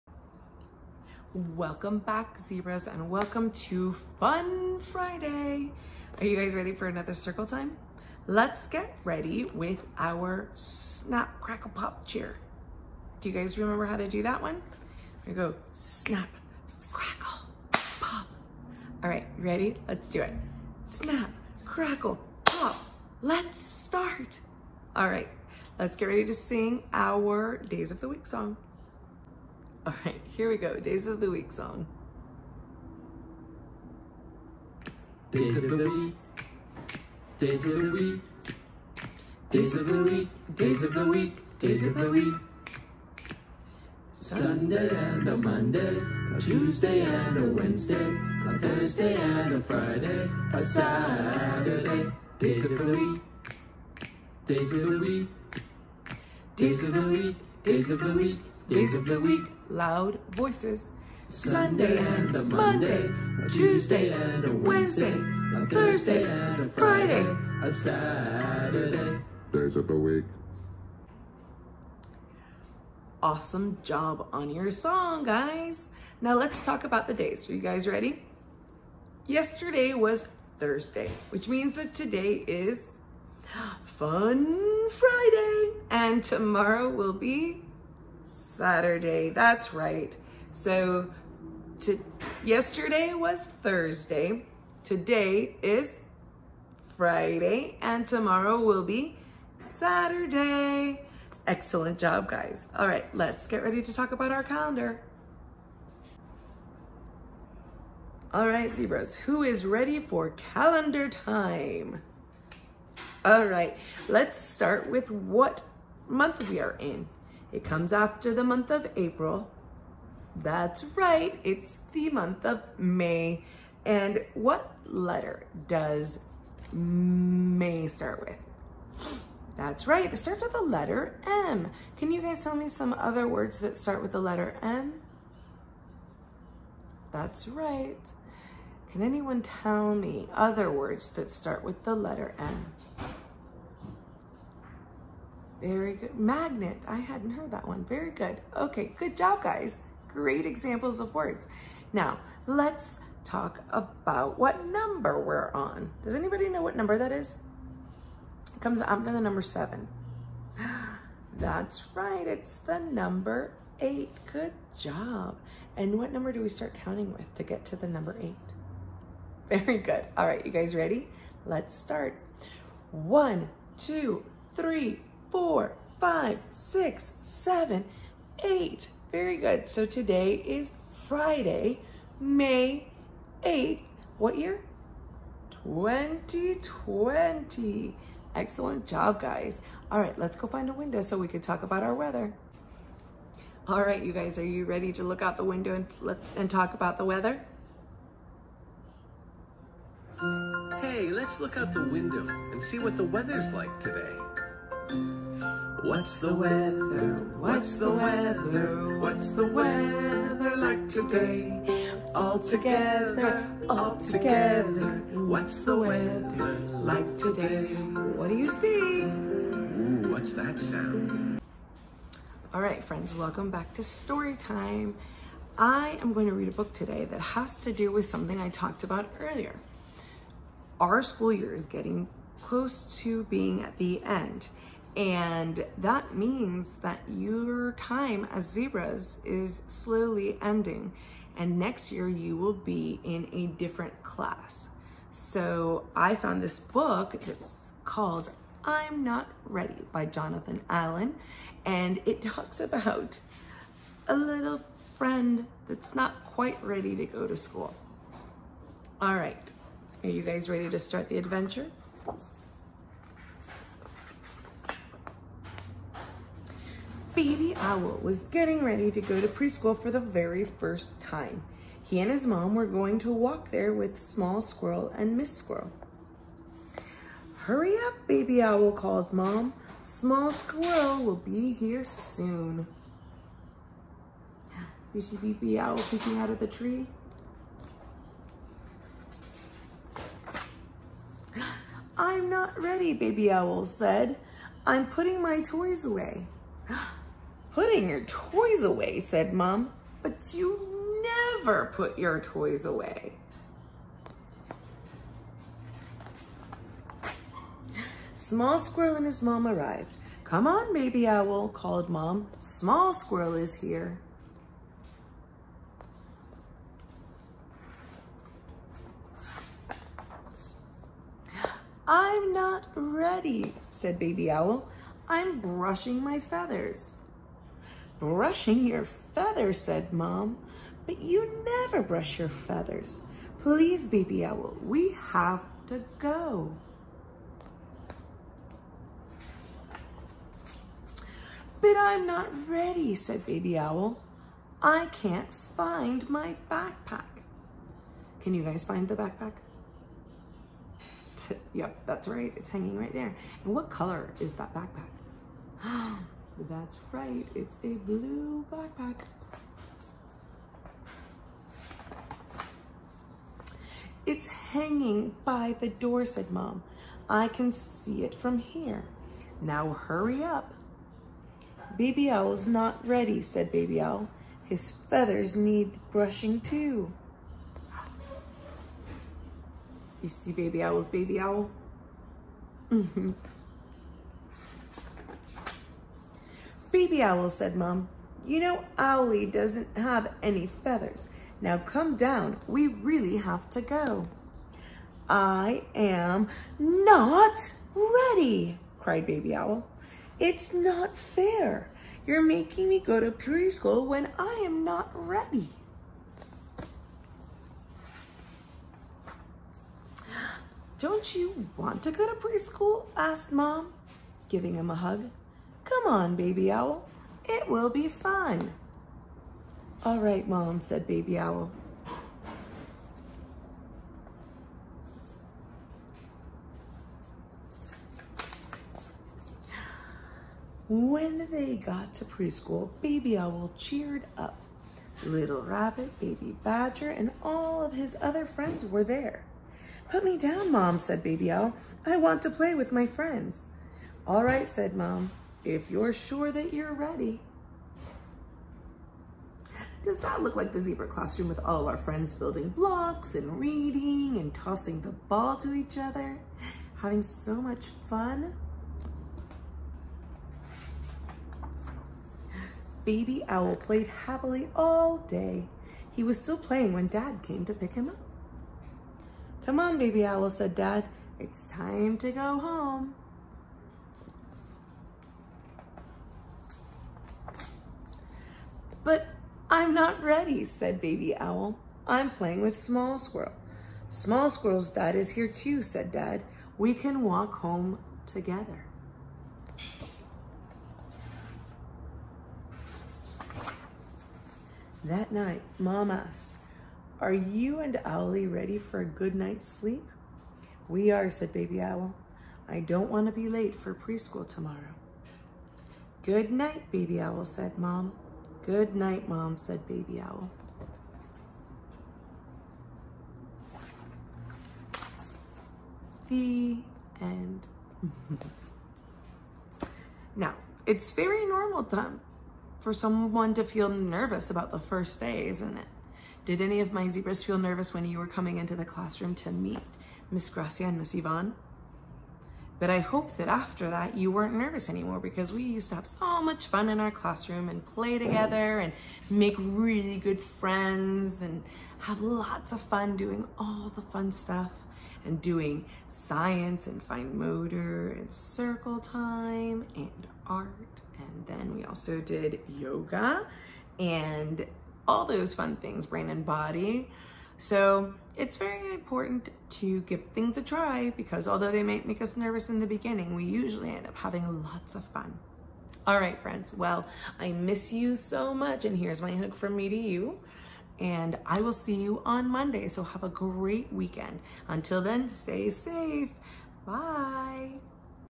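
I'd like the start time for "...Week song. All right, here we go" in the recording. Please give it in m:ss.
0:28.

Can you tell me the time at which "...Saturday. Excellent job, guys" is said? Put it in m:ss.
1:39.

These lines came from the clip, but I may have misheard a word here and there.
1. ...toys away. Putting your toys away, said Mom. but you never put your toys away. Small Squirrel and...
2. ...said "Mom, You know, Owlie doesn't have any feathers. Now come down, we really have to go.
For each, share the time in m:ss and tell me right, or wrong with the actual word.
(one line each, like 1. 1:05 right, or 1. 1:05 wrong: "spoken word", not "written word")
1. 4:55 right
2. 6:27 right.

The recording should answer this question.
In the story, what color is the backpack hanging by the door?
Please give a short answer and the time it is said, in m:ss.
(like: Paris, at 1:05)
Blue, at 5:57.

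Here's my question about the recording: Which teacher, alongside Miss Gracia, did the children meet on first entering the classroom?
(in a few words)
Miss Ivonne.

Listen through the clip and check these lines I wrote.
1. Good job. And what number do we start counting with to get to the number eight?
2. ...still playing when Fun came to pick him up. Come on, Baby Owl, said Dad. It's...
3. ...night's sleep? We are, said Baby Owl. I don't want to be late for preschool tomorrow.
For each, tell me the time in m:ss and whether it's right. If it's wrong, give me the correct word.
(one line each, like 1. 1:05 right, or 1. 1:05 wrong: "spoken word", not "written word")
1. 2:44 right
2. 7:46 wrong: "Dad", not "Fun"
3. 8:19 right.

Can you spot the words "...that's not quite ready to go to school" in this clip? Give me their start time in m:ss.
4:15.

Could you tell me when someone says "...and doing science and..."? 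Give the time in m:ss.
9:05.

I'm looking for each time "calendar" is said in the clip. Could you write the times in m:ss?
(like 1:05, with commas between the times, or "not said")
1:44, 1:50.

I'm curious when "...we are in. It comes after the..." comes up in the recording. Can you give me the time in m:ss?
1:56.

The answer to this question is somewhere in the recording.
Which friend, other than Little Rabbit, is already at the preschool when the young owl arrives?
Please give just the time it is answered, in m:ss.
7:15.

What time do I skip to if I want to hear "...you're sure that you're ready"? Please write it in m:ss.
7:25.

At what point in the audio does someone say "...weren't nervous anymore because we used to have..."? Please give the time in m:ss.
8:54.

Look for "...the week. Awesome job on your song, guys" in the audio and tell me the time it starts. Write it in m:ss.
1:09.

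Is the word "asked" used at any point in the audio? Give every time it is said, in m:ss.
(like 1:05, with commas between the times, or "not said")
6:52, 8:15.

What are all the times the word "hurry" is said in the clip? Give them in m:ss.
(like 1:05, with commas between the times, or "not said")
4:37, 6:09.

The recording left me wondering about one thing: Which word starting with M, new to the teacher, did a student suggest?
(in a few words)
Magnet.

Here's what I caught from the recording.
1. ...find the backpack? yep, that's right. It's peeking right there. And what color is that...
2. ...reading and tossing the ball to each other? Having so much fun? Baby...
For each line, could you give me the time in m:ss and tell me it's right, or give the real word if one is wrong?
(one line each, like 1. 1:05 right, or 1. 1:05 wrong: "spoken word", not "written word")
1. 5:48 wrong: "hanging", not "peeking"
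2. 7:33 right.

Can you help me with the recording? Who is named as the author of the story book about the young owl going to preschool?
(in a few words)
Jonathan Allen.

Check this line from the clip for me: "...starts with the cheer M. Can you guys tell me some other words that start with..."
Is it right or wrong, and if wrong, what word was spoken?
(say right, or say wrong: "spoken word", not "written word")
wrong: "letter", not "cheer".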